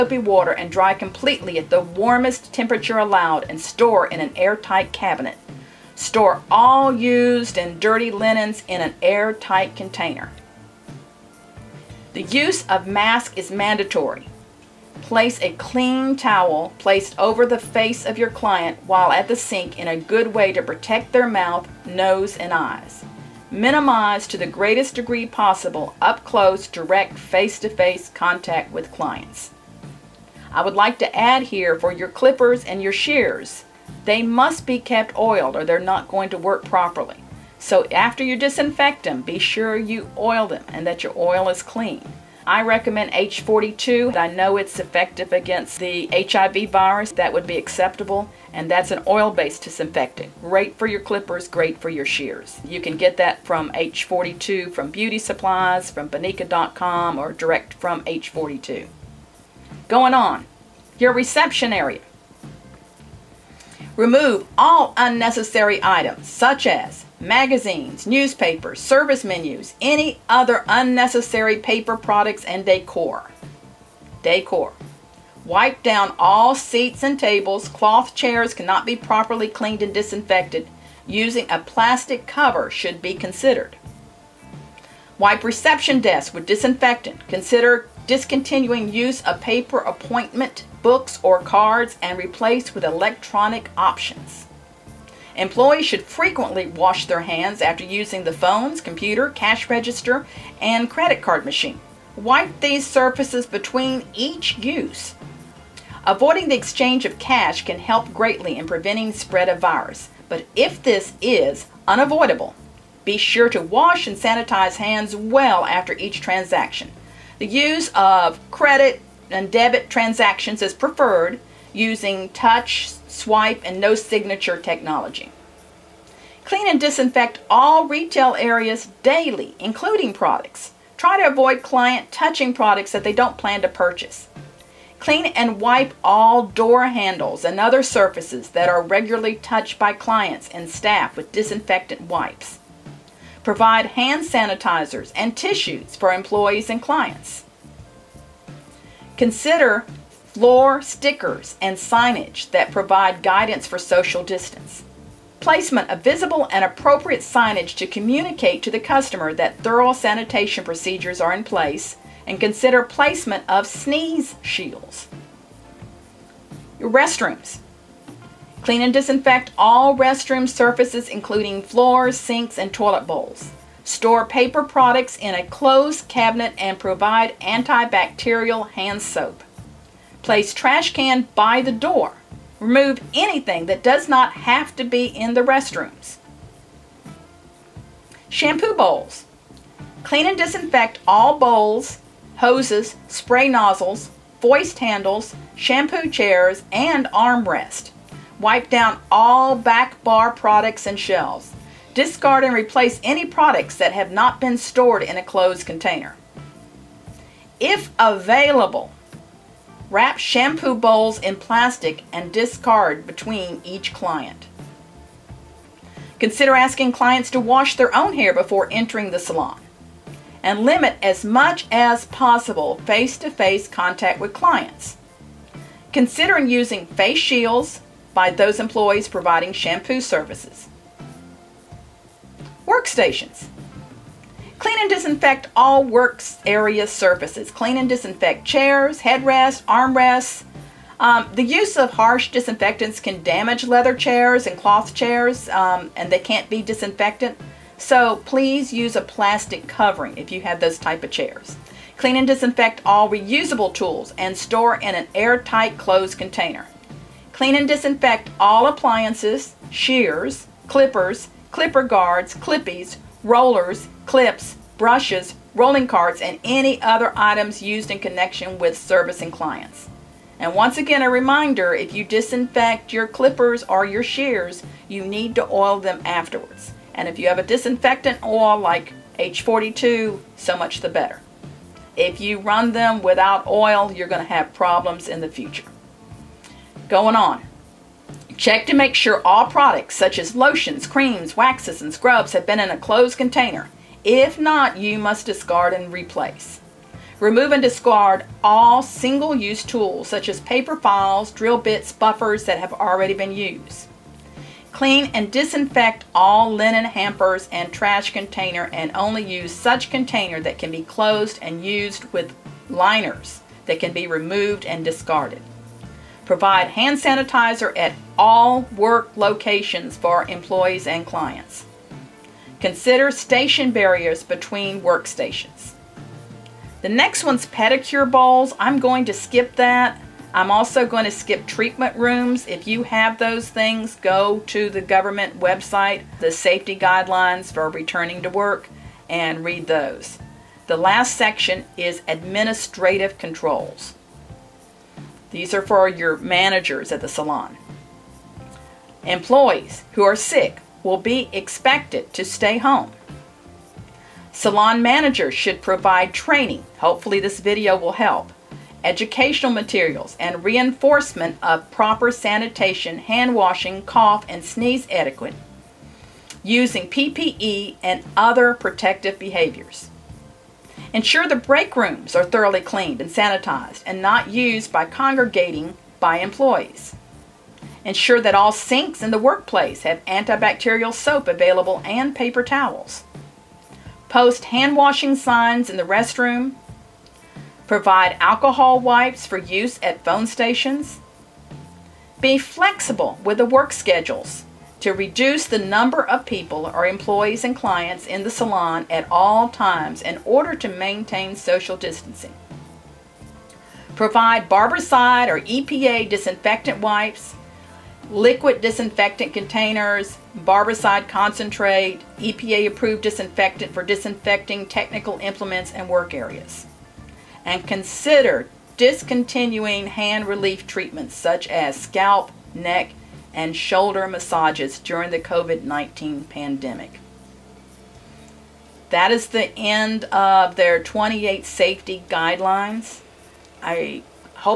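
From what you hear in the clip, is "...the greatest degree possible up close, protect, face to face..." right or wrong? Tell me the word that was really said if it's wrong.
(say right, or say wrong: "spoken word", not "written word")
wrong: "direct", not "protect".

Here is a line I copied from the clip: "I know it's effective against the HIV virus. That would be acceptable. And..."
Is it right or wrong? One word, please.
right.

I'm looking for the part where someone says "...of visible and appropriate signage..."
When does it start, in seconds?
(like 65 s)
155 s.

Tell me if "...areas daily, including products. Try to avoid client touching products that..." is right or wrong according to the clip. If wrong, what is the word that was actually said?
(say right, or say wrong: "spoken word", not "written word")
right.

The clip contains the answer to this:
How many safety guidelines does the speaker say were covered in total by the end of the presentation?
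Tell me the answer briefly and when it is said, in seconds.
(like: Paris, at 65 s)
28, at 430 s.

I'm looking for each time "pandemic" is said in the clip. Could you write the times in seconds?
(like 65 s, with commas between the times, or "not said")
426 s.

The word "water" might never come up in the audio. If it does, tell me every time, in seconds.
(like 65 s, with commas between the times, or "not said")
0 s.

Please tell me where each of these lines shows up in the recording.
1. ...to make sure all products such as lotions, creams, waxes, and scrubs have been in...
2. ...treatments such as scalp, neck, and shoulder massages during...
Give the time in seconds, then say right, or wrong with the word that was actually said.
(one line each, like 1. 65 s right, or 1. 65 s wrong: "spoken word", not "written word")
1. 288 s right
2. 420 s right.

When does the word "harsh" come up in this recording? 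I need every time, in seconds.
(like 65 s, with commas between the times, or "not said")
241 s.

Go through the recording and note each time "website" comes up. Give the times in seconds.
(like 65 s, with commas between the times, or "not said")
335 s.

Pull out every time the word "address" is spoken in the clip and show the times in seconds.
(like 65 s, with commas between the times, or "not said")
not said.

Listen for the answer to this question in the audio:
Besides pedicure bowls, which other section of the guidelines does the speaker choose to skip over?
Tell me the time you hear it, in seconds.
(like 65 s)
331 s.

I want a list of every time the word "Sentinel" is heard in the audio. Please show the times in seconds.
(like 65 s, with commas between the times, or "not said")
not said.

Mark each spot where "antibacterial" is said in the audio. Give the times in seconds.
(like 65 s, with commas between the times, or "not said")
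177 s, 380 s.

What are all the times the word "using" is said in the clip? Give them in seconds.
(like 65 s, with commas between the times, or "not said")
81 s, 97 s, 121 s, 226 s, 366 s.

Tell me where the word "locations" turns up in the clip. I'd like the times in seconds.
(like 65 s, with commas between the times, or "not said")
319 s.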